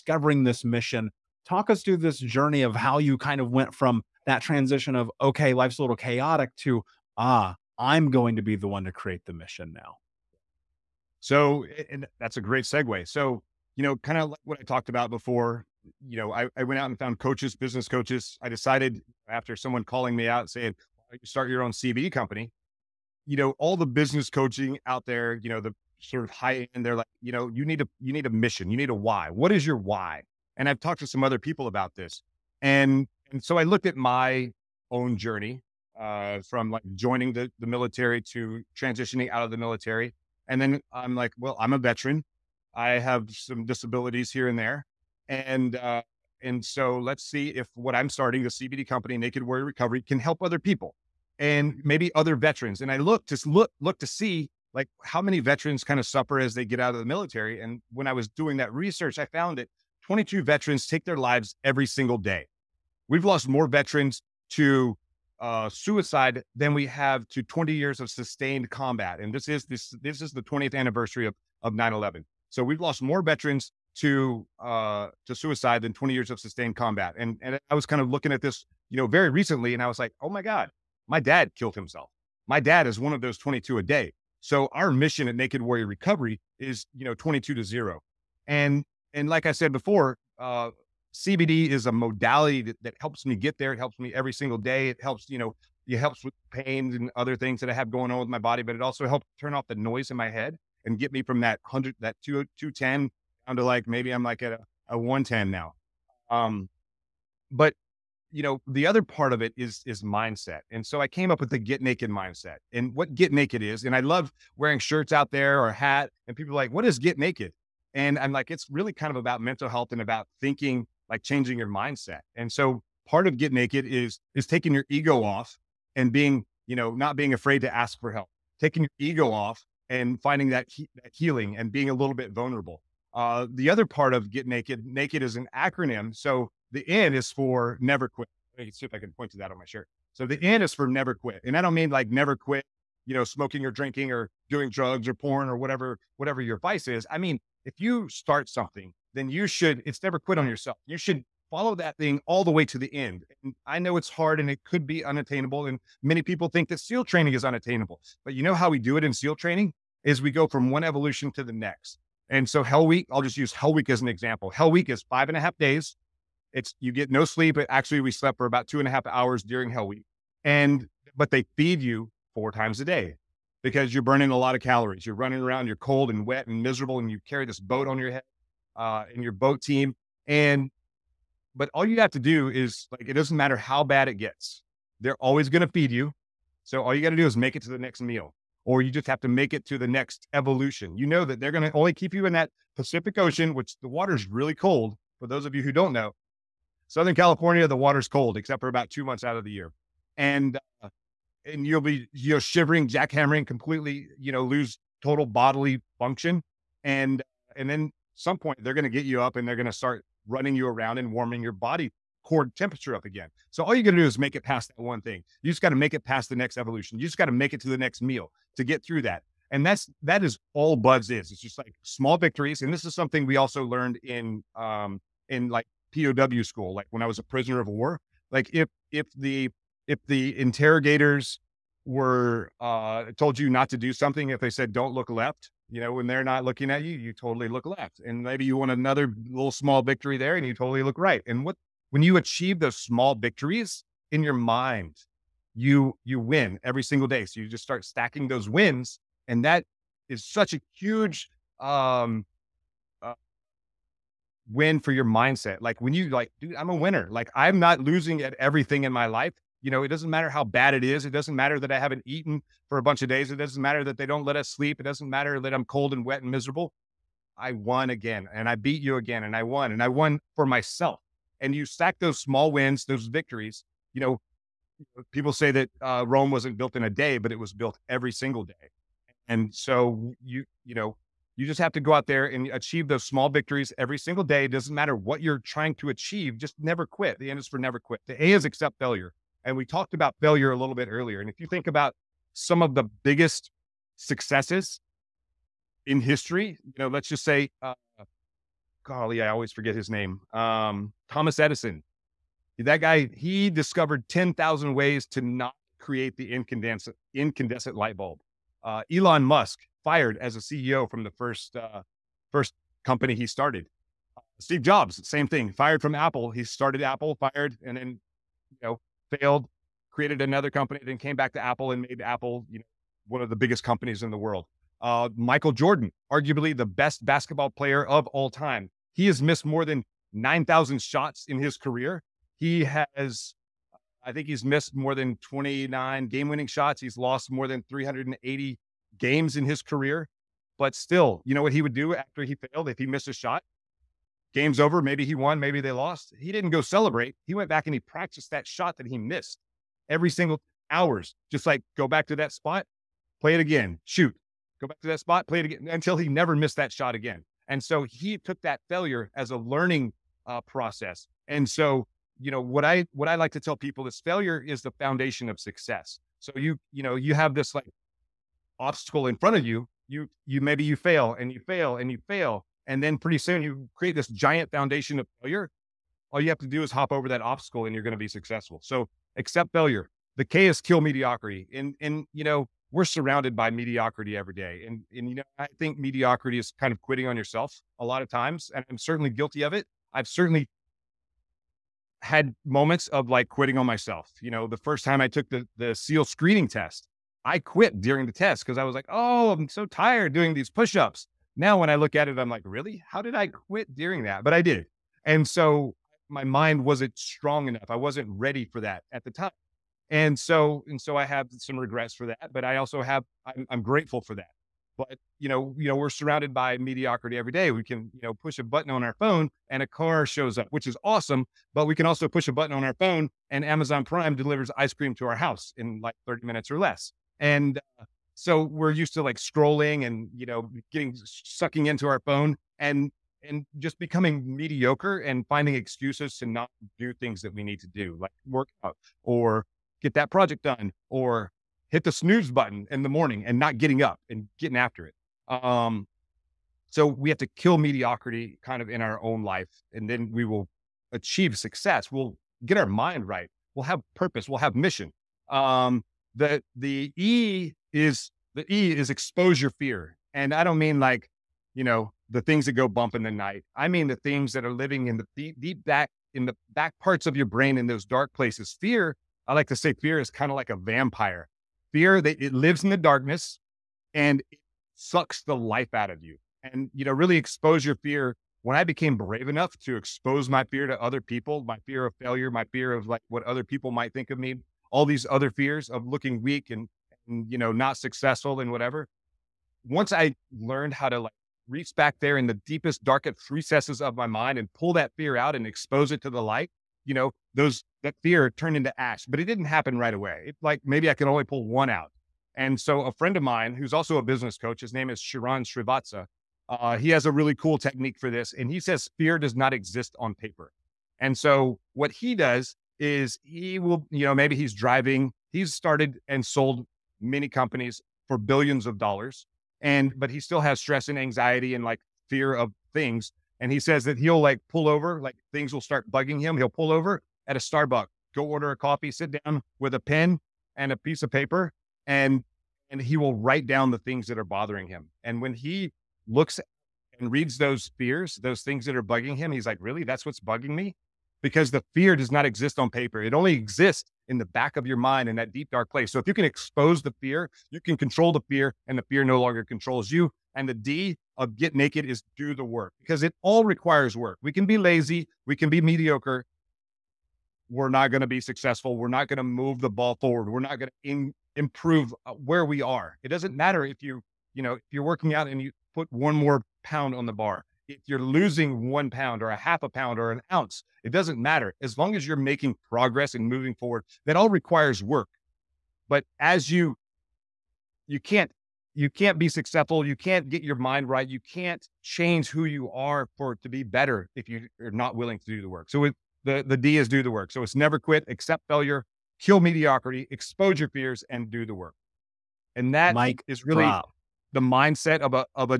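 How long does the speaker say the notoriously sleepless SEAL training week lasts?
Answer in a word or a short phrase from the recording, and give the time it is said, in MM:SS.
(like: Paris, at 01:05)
Five and a half days, at 02:45.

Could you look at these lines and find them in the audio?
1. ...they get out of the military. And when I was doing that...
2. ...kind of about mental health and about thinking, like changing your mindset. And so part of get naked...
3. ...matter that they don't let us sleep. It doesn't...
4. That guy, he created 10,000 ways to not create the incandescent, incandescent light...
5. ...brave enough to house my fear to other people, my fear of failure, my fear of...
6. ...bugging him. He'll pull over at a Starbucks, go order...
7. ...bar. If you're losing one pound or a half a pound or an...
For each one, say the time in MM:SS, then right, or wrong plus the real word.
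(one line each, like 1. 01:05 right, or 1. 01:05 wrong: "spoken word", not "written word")
1. 00:56 right
2. 01:58 right
3. 04:23 right
4. 05:02 wrong: "discovered", not "created"
5. 07:58 wrong: "expose", not "house"
6. 08:45 right
7. 09:27 right.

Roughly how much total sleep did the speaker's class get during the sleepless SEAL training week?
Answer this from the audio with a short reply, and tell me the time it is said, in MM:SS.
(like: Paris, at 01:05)
About two and a half hours, at 02:48.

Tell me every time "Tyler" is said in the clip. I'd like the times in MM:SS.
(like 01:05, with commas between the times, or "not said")
not said.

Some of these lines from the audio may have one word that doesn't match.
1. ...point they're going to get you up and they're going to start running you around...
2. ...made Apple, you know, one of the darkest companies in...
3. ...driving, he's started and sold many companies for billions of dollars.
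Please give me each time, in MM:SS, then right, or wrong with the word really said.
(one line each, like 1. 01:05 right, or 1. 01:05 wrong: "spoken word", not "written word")
1. 03:28 right
2. 05:21 wrong: "biggest", not "darkest"
3. 08:34 right.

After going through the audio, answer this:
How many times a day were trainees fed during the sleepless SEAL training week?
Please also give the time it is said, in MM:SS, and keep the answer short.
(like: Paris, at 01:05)
Four, at 02:52.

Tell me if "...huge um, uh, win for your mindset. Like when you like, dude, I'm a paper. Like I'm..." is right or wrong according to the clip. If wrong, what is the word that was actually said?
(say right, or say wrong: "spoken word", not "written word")
wrong: "winner", not "paper".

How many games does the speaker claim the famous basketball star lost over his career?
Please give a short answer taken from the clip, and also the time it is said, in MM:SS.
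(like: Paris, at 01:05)
More than 380, at 05:37.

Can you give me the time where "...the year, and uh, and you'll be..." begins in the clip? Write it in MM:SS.
03:19.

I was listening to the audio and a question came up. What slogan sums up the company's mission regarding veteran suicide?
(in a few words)
22 to zero.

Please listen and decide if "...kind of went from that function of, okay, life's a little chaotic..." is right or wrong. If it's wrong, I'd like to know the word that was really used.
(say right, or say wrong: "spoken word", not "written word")
wrong: "transition", not "function".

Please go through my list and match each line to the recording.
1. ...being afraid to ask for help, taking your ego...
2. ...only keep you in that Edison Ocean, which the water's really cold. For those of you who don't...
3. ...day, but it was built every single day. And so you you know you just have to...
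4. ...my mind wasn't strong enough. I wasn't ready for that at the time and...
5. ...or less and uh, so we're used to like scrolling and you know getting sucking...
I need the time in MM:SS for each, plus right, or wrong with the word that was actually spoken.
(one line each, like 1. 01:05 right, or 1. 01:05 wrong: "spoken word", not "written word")
1. 02:07 right
2. 03:11 wrong: "Pacific", not "Edison"
3. 04:36 right
4. 06:46 right
5. 07:06 right.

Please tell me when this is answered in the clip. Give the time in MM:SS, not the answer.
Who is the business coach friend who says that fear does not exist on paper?
08:24.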